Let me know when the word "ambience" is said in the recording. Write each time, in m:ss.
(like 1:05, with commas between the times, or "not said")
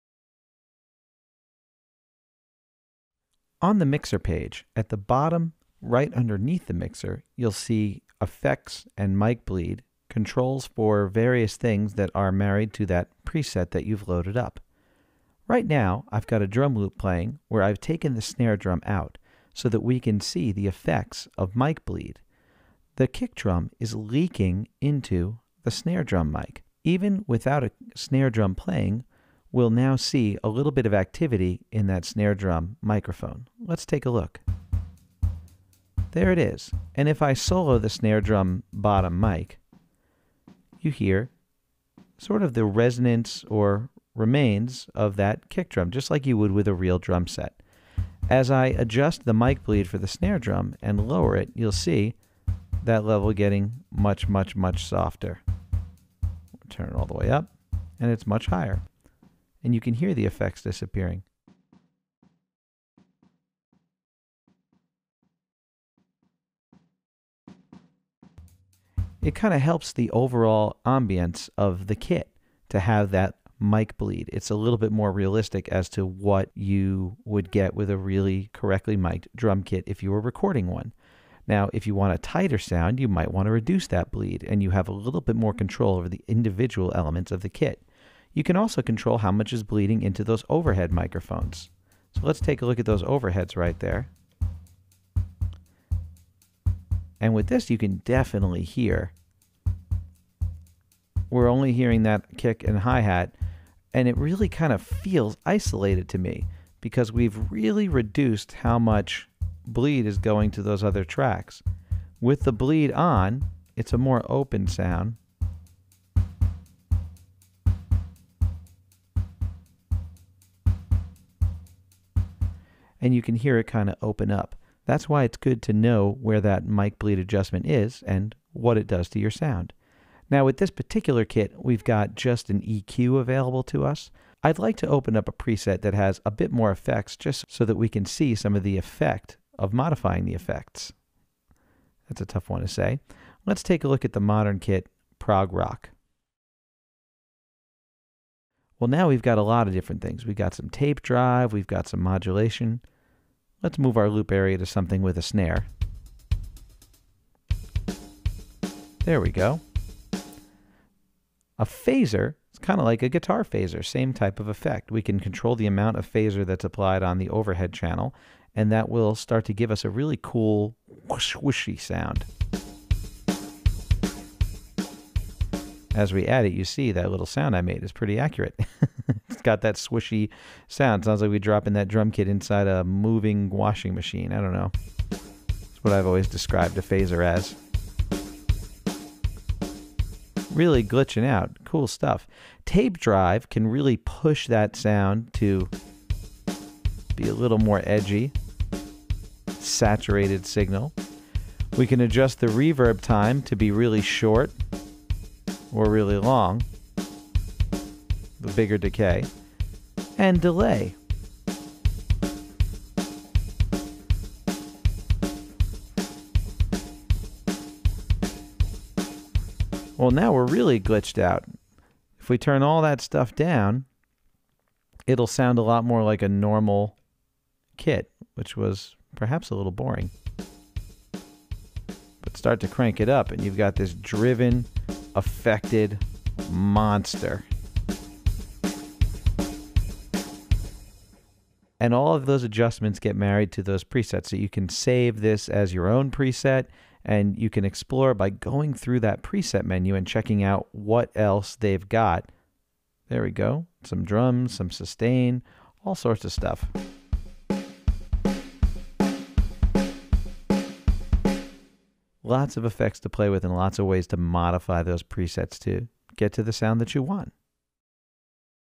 1:10.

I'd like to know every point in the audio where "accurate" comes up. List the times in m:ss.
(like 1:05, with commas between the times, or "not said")
2:58.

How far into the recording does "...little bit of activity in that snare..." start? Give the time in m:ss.
0:30.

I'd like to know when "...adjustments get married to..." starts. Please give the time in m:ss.
4:02.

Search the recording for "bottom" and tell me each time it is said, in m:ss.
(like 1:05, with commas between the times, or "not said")
0:04, 0:38.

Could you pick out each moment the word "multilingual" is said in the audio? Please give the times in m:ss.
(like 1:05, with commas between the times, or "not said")
not said.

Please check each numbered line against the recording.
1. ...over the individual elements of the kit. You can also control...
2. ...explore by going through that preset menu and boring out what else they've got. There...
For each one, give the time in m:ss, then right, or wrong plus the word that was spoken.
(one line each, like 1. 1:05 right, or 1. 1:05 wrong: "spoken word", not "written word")
1. 1:25 right
2. 4:07 wrong: "checking", not "boring".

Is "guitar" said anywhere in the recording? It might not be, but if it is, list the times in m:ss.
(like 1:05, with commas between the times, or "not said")
2:43.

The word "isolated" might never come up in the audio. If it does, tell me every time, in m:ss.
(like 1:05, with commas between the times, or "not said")
1:45.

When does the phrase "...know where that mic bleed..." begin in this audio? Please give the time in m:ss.
2:05.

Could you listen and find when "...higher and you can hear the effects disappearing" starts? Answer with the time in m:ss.
0:58.